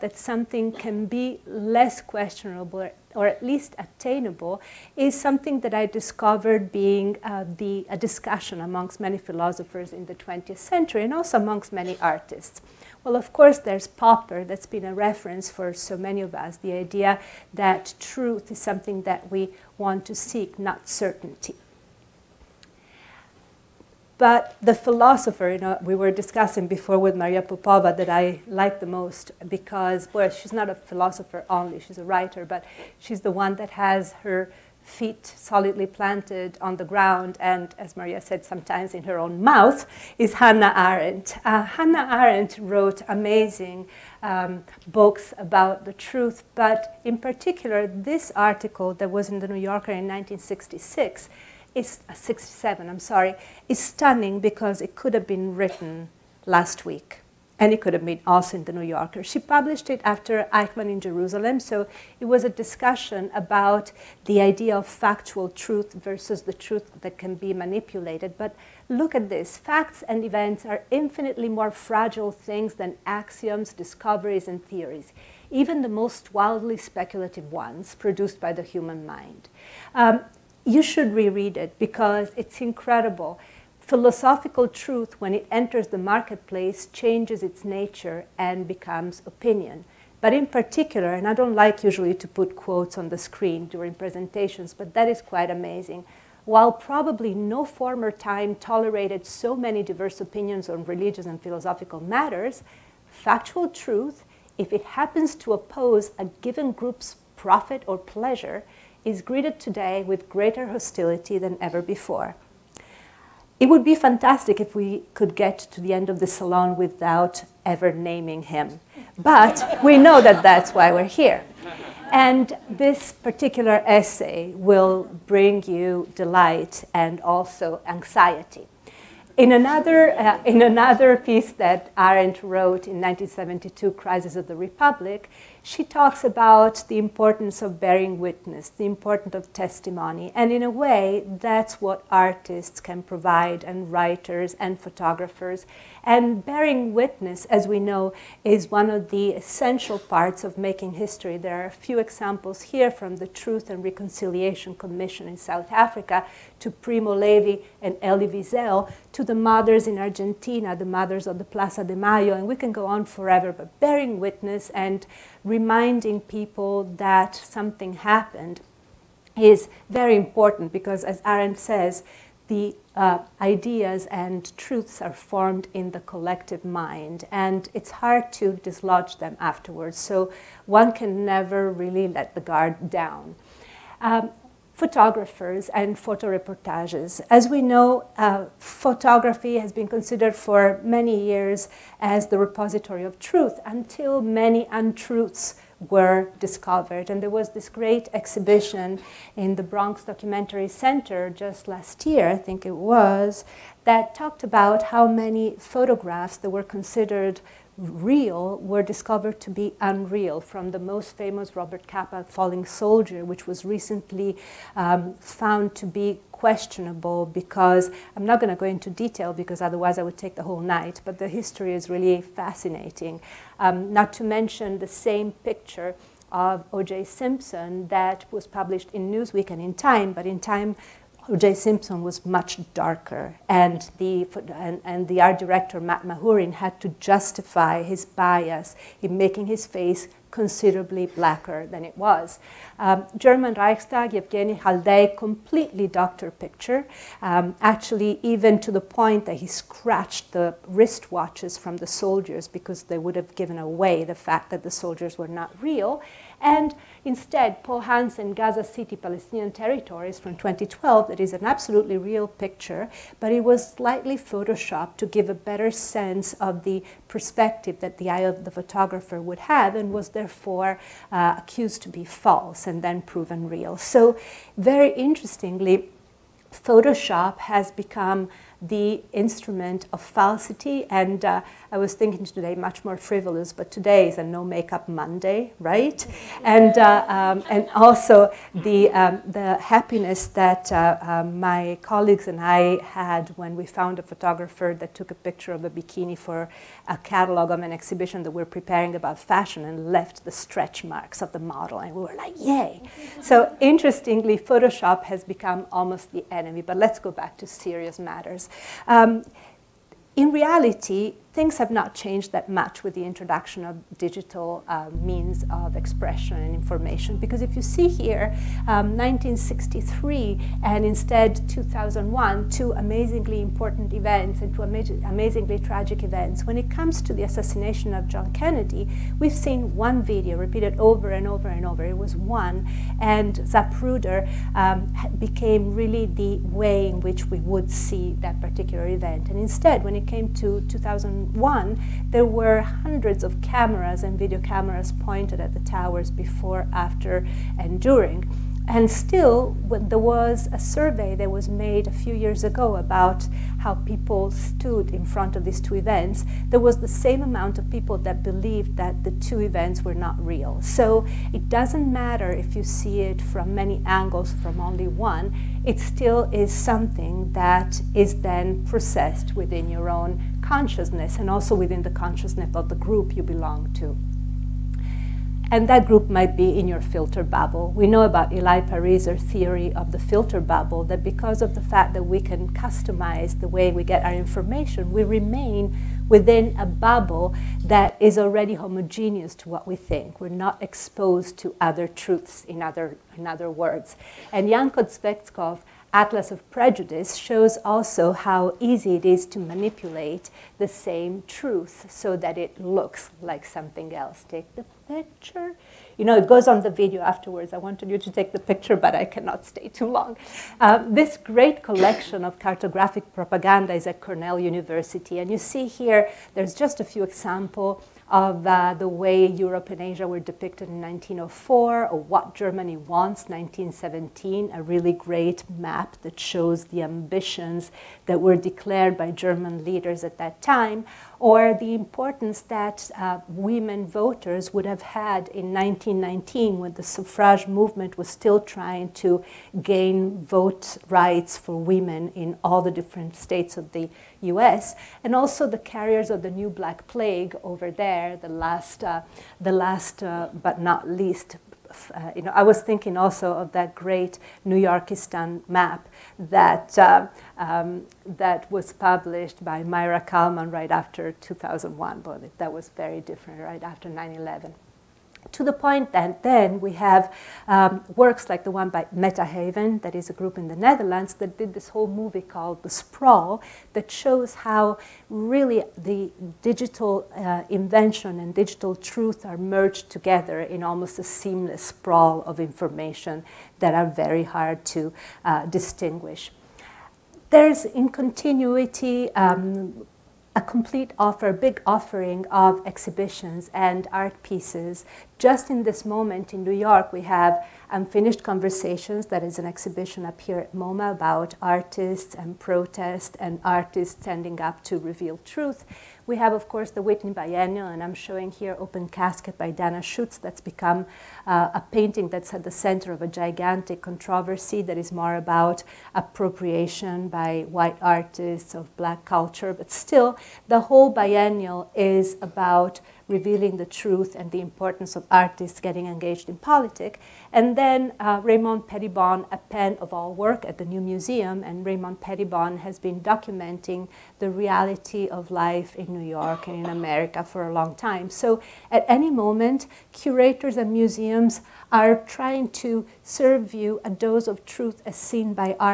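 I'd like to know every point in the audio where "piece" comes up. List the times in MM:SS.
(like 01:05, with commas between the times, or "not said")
02:11, 08:14.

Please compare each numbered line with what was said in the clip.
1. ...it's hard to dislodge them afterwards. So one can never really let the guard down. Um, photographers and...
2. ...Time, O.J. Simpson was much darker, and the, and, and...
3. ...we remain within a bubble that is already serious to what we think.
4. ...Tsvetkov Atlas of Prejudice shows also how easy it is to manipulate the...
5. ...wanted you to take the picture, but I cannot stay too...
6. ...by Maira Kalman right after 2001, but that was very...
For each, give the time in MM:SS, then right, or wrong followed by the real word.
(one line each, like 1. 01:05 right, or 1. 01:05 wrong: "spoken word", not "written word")
1. 02:57 right
2. 03:50 right
3. 06:24 wrong: "homogeneous", not "serious"
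4. 06:34 right
5. 06:47 right
6. 07:39 right.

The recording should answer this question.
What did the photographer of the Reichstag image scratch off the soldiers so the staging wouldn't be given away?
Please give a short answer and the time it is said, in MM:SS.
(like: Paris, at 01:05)
wristwatches, at 04:10.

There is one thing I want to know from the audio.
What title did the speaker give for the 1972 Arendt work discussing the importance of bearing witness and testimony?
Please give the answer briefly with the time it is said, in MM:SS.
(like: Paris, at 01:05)
Crisis of the Republic, at 02:13.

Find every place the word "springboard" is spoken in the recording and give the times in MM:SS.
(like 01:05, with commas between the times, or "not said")
not said.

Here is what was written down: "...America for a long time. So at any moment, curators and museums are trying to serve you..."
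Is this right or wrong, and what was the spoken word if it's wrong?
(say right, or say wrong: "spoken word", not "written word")
right.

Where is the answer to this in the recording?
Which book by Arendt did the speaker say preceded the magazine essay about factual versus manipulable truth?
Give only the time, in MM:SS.
01:00.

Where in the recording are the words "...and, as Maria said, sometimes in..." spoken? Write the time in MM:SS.
00:37.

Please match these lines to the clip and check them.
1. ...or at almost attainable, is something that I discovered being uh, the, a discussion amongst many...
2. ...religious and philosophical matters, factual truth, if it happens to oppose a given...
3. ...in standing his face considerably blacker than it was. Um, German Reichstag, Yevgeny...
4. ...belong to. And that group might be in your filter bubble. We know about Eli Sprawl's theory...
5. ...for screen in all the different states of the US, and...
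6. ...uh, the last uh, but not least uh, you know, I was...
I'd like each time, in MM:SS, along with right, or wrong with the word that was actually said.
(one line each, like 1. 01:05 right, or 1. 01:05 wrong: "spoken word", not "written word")
1. 00:03 wrong: "least", not "almost"
2. 01:40 right
3. 03:59 wrong: "making", not "standing"
4. 06:13 wrong: "Pariser", not "Sprawl"
5. 07:21 wrong: "women", not "screen"
6. 07:28 right.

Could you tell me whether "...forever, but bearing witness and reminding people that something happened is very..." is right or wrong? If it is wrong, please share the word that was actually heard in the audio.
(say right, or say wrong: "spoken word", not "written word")
right.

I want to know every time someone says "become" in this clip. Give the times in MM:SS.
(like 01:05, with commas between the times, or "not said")
01:28, 04:37, 05:05, 08:30.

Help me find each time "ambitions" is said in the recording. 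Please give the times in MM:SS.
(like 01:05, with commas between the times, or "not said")
07:06.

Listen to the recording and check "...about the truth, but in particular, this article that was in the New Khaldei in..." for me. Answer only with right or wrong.
wrong.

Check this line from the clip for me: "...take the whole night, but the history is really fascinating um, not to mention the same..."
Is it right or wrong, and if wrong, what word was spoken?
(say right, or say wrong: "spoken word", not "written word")
right.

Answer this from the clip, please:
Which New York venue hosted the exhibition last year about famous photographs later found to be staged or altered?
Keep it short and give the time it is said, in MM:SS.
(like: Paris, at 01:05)
Bronx Documentary Center, at 03:19.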